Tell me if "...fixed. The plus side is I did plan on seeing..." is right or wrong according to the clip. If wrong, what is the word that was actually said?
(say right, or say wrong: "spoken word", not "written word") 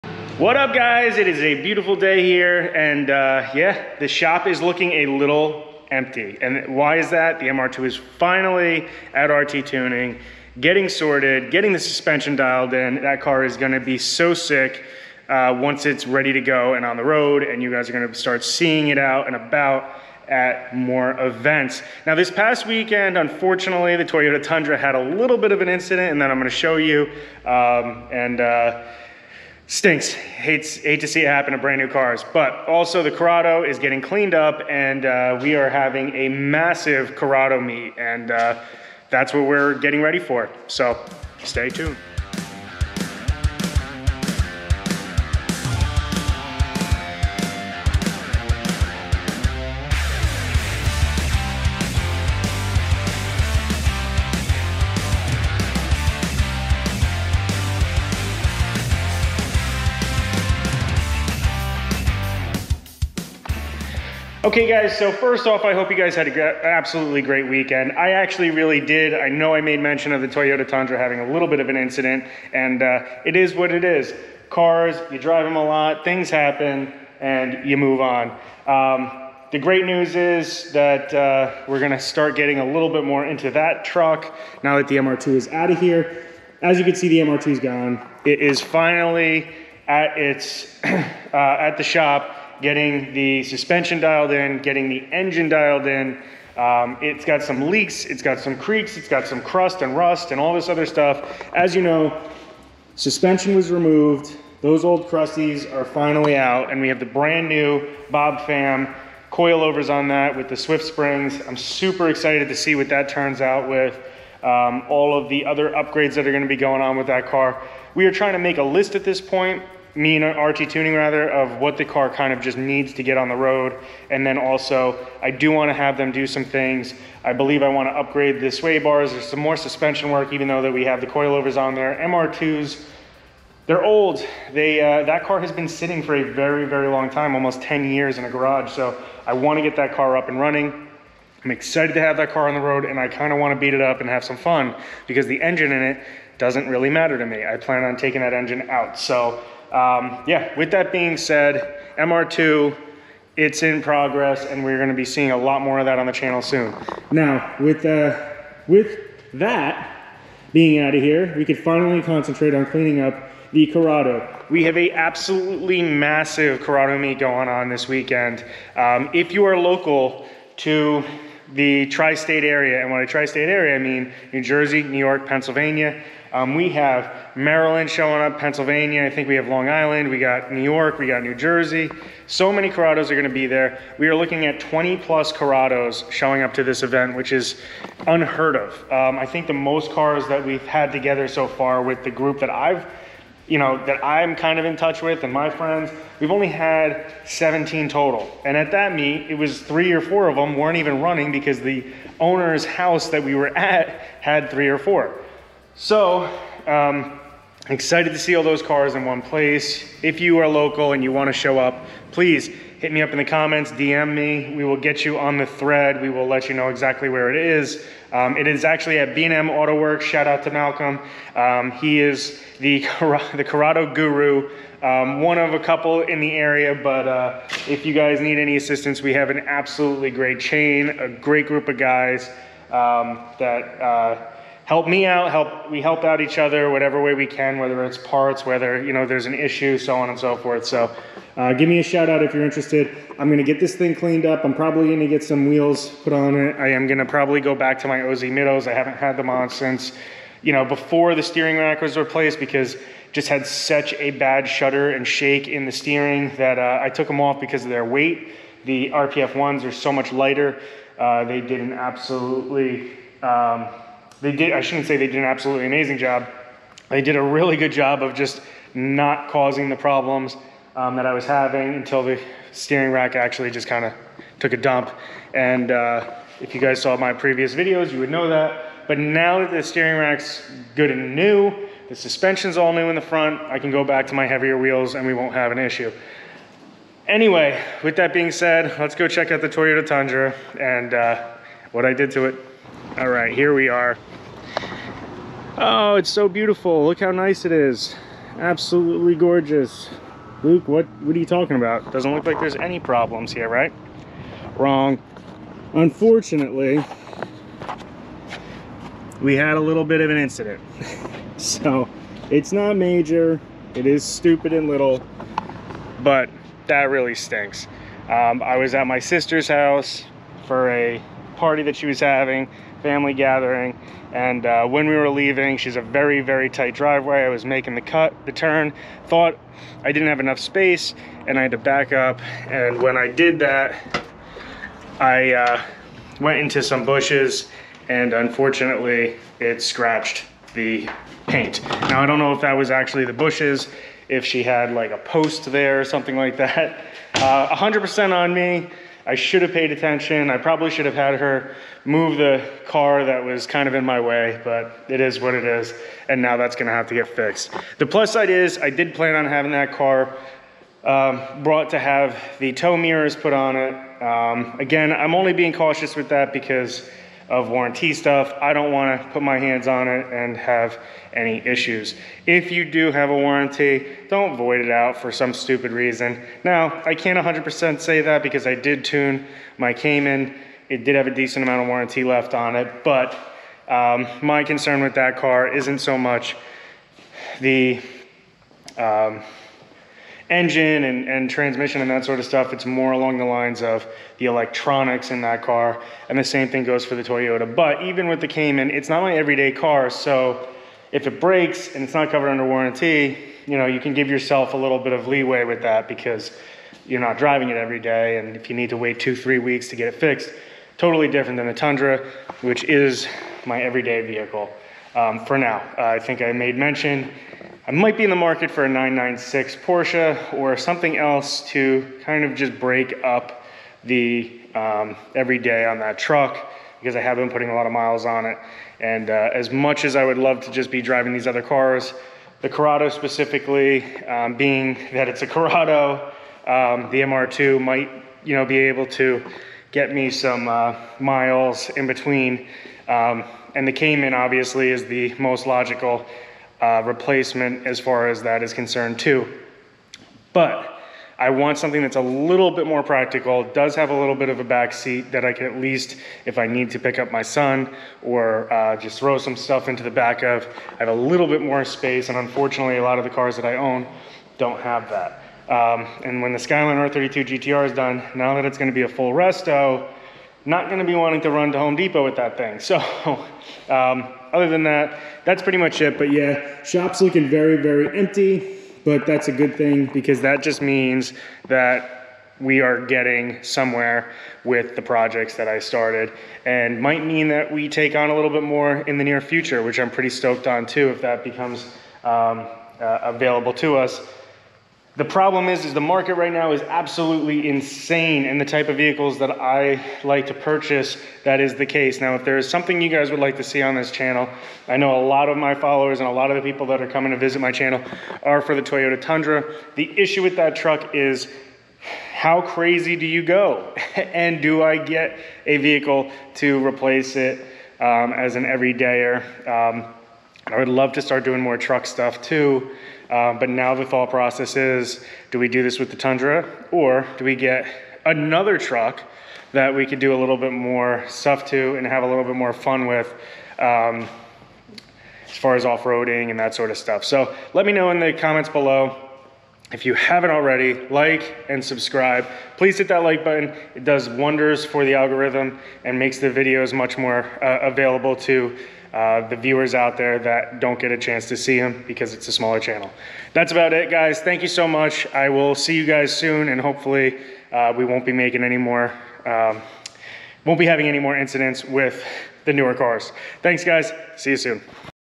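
wrong: "having", not "seeing".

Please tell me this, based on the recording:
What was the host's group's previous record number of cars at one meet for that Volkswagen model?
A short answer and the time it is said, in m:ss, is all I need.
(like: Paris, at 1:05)
17, at 3:17.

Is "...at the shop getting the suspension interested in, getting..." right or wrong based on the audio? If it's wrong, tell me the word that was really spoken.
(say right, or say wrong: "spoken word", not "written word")
wrong: "dialed", not "interested".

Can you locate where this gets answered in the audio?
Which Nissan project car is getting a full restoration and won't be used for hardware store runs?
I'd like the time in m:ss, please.
7:46.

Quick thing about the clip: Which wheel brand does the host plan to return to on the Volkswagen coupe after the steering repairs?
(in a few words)
OZ.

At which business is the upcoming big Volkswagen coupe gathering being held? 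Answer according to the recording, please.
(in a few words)
B&M Auto Works.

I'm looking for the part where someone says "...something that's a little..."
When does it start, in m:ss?
7:31.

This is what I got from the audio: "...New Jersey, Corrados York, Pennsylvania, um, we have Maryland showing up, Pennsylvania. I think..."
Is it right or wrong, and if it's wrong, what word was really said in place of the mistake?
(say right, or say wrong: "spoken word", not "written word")
wrong: "New", not "Corrados".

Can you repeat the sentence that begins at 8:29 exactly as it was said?
The issue with that truck is how crazy do you go?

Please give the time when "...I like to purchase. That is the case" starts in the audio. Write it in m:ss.
8:19.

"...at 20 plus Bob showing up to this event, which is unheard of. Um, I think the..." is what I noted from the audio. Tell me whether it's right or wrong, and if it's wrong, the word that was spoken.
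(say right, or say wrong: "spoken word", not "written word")
wrong: "Corrados", not "Bob".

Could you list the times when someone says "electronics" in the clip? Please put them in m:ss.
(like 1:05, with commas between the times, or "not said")
6:34.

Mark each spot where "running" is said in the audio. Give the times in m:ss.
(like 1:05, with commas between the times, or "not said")
2:20, 3:21.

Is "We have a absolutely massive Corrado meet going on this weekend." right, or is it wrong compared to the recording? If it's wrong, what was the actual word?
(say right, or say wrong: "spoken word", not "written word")
right.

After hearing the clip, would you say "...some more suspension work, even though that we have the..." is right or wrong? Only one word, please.
right.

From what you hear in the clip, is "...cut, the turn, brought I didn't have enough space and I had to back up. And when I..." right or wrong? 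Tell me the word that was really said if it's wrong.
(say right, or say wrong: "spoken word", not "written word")
wrong: "thought", not "brought".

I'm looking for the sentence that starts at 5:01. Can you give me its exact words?
Doesn't look like there's any problems here, right?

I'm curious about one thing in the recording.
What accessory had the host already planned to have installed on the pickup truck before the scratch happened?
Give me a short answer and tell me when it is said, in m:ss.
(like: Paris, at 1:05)
tow mirrors, at 6:02.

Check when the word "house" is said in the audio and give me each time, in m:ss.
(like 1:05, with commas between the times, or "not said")
3:22, 5:19.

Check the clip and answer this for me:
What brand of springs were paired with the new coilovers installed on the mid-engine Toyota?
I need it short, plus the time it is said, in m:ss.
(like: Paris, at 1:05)
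Swift, at 1:50.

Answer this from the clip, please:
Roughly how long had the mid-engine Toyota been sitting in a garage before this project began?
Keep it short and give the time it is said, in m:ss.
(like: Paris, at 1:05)
almost 10 years, at 2:17.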